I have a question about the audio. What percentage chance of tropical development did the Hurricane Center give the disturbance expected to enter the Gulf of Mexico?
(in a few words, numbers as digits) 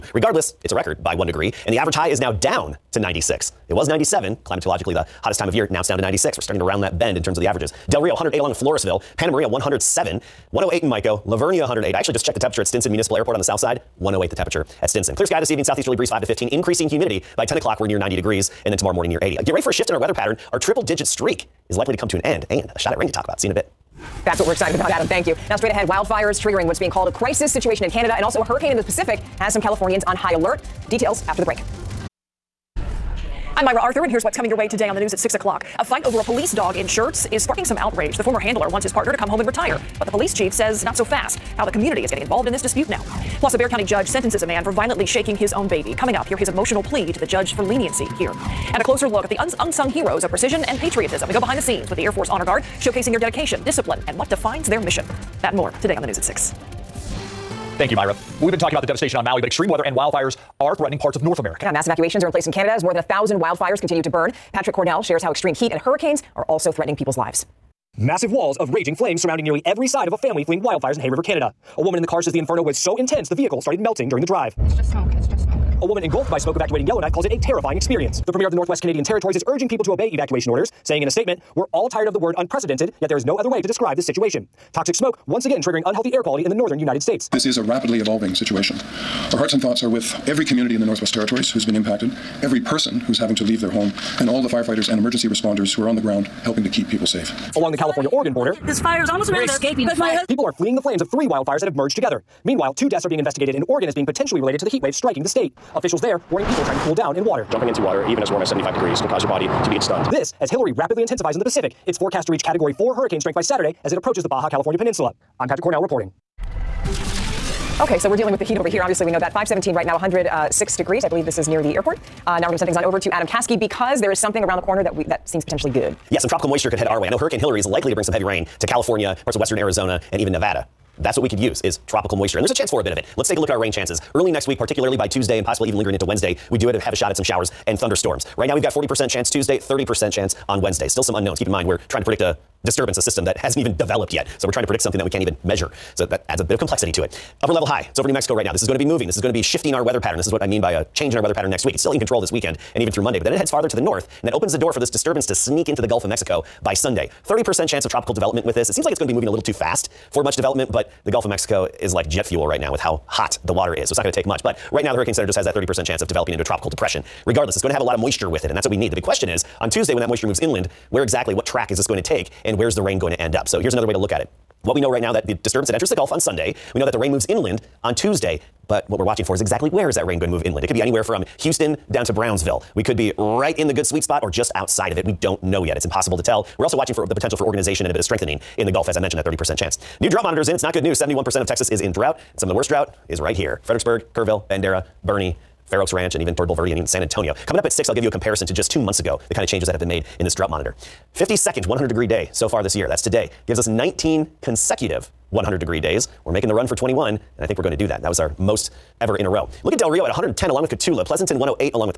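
30%.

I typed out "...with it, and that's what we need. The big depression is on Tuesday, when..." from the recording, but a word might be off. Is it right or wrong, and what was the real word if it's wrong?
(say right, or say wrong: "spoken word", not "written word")
wrong: "question", not "depression".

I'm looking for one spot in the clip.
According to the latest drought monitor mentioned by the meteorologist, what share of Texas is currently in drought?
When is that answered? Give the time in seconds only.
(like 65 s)
190 s.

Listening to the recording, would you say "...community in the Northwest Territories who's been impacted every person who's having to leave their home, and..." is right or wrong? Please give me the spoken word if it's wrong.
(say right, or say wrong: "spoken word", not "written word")
right.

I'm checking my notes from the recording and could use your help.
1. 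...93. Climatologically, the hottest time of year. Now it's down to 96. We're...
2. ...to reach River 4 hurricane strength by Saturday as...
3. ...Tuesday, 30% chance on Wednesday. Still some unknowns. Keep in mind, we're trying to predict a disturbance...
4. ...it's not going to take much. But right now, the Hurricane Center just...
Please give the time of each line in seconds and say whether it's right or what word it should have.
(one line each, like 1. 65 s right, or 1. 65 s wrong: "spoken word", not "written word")
1. 3 s wrong: "97", not "93"
2. 112 s wrong: "Category", not "River"
3. 139 s right
4. 163 s right.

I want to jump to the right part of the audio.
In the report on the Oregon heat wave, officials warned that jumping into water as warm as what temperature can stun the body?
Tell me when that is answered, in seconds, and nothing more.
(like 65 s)
108 s.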